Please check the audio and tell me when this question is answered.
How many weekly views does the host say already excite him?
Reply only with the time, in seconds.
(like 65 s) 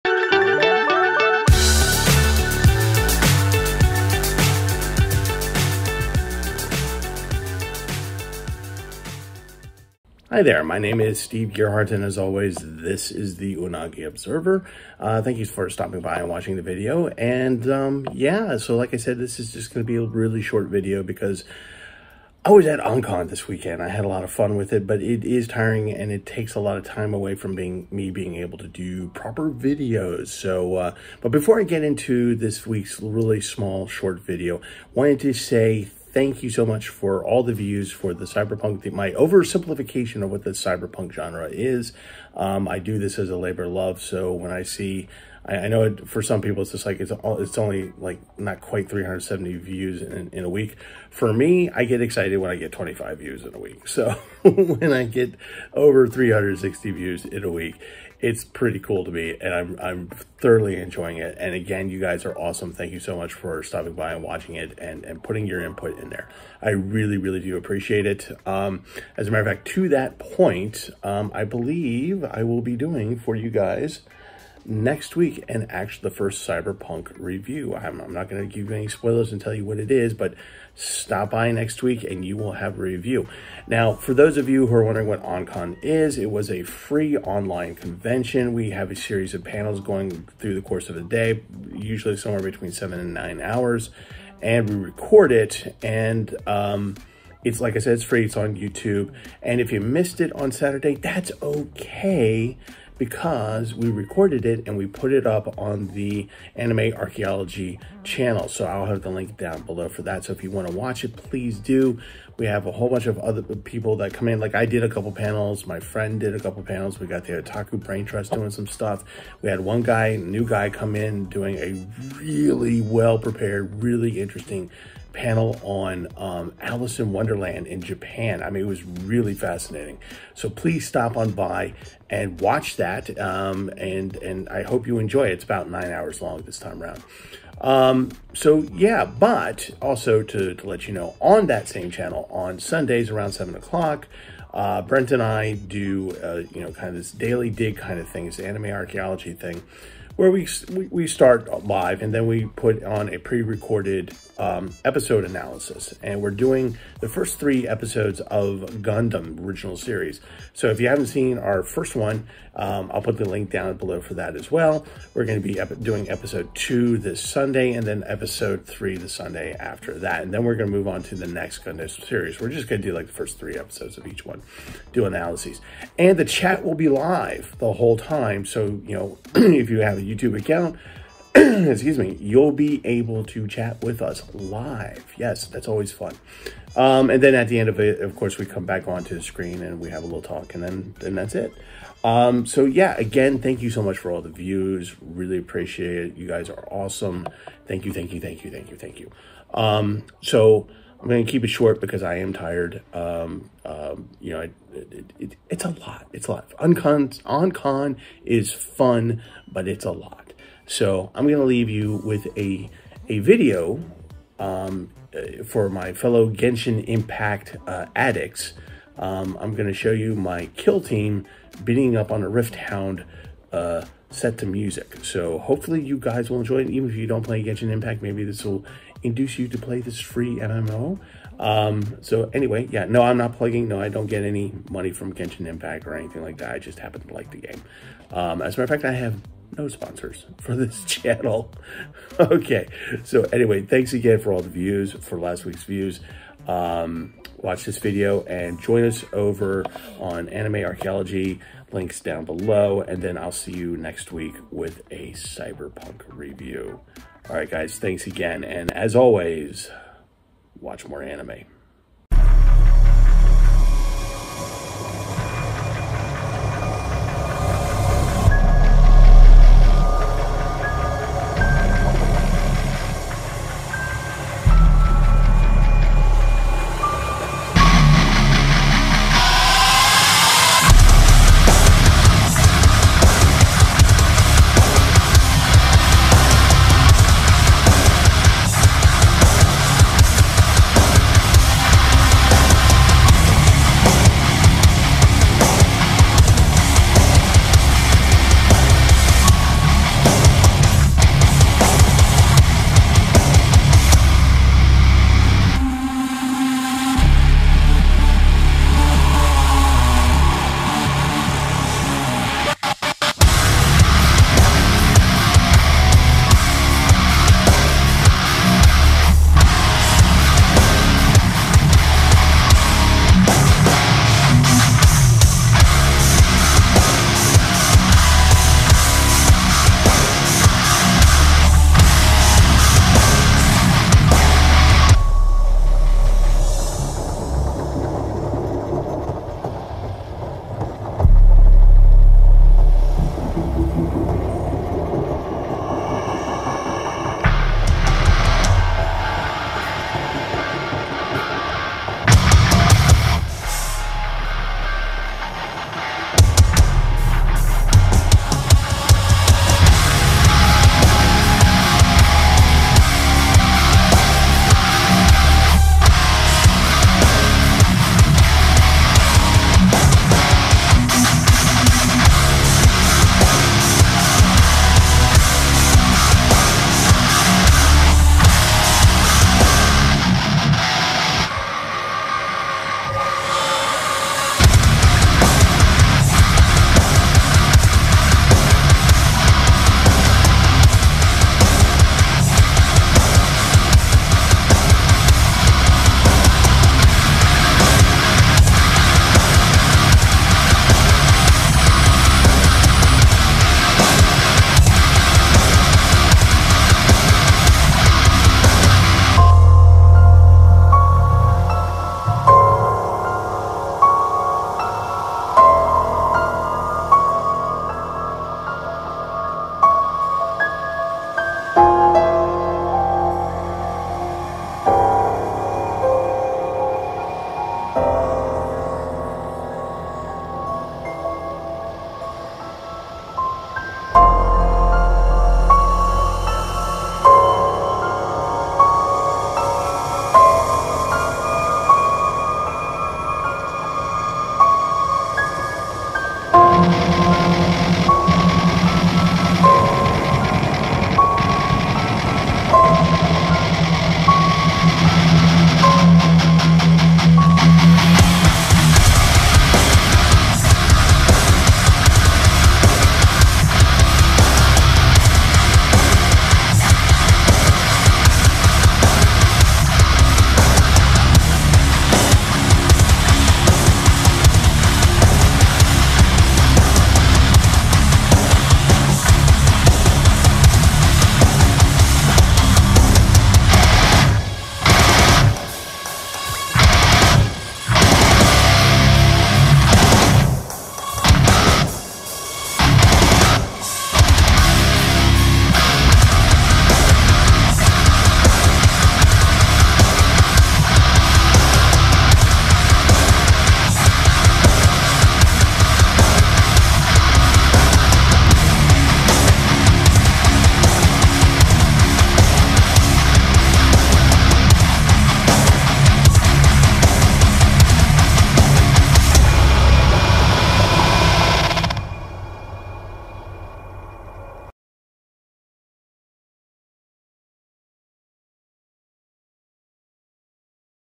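52 s.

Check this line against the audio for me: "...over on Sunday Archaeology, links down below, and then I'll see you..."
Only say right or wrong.
wrong.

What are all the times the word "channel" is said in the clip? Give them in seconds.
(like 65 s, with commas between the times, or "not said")
108 s, 141 s, 240 s.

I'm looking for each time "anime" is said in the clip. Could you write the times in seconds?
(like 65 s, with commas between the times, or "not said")
106 s, 148 s, 250 s, 261 s.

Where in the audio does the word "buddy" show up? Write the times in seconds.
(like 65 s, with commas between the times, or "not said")
not said.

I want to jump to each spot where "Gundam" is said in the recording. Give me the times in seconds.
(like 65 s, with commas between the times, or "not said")
158 s, 171 s.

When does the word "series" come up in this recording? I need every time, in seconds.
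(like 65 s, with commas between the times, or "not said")
88 s, 159 s, 172 s.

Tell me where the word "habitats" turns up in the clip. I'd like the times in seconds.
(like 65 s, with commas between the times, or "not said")
not said.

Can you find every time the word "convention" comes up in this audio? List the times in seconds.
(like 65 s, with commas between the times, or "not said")
87 s.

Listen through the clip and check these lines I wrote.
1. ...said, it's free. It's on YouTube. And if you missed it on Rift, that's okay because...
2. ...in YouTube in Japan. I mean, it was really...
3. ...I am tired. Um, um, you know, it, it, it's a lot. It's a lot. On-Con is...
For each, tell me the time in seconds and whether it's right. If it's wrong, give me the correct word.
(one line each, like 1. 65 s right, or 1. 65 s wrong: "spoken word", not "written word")
1. 97 s wrong: "Saturday", not "Rift"
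2. 126 s wrong: "Wonderland", not "YouTube"
3. 202 s right.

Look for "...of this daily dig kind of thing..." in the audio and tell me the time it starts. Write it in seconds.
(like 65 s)
146 s.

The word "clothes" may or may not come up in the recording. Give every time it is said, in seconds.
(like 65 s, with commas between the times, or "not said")
not said.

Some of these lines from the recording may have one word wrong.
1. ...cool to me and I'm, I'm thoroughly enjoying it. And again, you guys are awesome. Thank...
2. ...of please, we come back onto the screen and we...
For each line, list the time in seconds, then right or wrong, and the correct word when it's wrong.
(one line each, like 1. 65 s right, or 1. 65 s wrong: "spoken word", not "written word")
1. 58 s right
2. 188 s wrong: "course", not "please".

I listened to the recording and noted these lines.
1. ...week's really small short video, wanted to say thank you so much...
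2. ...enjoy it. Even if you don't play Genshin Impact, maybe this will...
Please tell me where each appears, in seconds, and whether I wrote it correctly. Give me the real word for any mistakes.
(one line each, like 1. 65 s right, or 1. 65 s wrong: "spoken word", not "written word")
1. 32 s right
2. 226 s right.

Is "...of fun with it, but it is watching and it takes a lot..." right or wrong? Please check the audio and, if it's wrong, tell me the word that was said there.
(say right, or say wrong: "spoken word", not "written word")
wrong: "tiring", not "watching".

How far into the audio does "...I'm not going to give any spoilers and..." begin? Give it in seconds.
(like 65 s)
77 s.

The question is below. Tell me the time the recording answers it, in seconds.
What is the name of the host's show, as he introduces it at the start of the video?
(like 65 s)
13 s.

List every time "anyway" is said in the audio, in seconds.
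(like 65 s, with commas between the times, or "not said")
232 s, 243 s.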